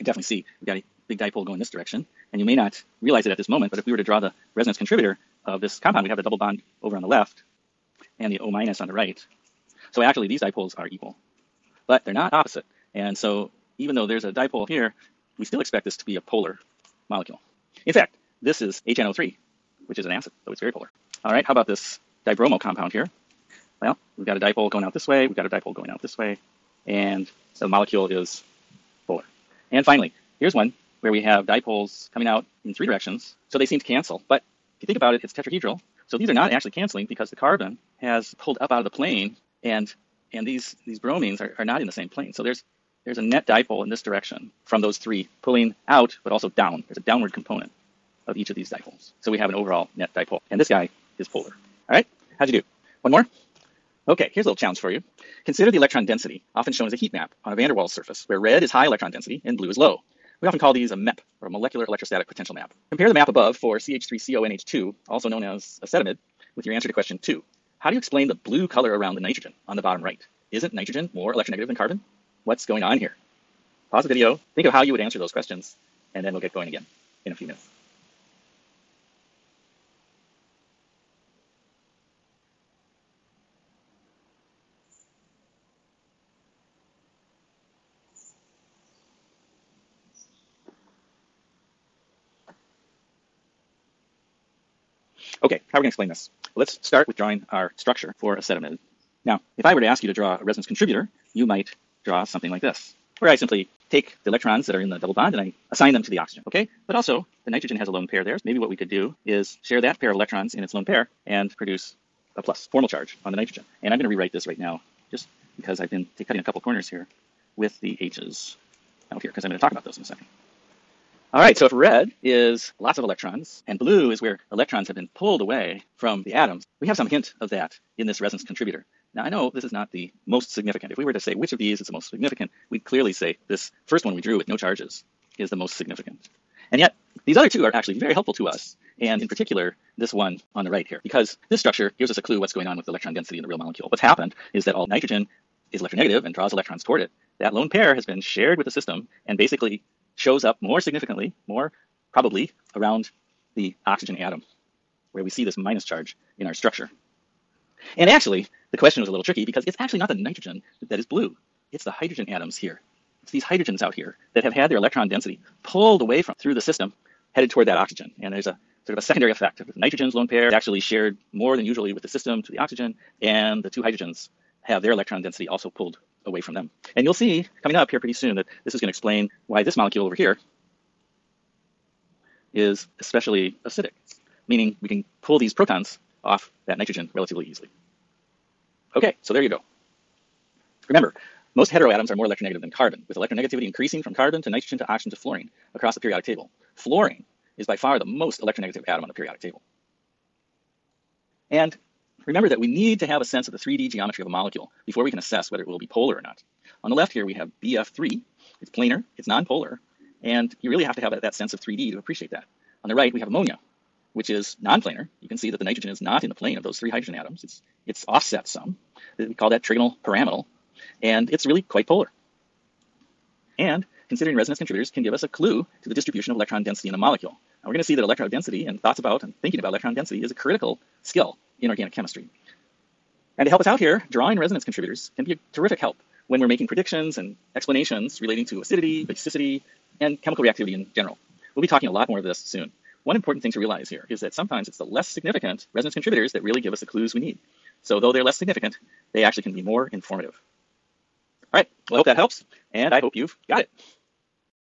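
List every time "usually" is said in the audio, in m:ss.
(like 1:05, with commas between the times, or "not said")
2:51.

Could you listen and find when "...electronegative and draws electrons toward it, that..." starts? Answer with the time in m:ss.
2:25.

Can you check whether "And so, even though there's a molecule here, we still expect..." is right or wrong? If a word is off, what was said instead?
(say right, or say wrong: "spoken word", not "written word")
wrong: "dipole", not "molecule".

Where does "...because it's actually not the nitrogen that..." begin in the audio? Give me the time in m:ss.
2:39.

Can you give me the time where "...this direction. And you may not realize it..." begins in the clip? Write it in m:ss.
0:01.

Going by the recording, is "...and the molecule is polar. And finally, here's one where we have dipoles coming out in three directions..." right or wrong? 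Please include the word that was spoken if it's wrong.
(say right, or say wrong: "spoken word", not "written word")
right.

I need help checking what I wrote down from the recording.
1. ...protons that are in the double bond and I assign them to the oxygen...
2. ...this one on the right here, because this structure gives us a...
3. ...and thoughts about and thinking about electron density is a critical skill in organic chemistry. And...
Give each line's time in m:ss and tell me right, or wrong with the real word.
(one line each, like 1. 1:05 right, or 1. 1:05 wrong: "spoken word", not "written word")
1. 1:44 wrong: "electrons", not "protons"
2. 2:19 right
3. 3:48 right.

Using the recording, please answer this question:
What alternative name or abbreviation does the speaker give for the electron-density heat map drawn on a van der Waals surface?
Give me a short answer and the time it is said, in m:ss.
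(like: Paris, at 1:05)
MEP, at 1:00.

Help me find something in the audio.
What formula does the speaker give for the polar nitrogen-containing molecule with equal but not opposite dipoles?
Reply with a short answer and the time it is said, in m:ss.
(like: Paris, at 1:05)
HNO3, at 0:18.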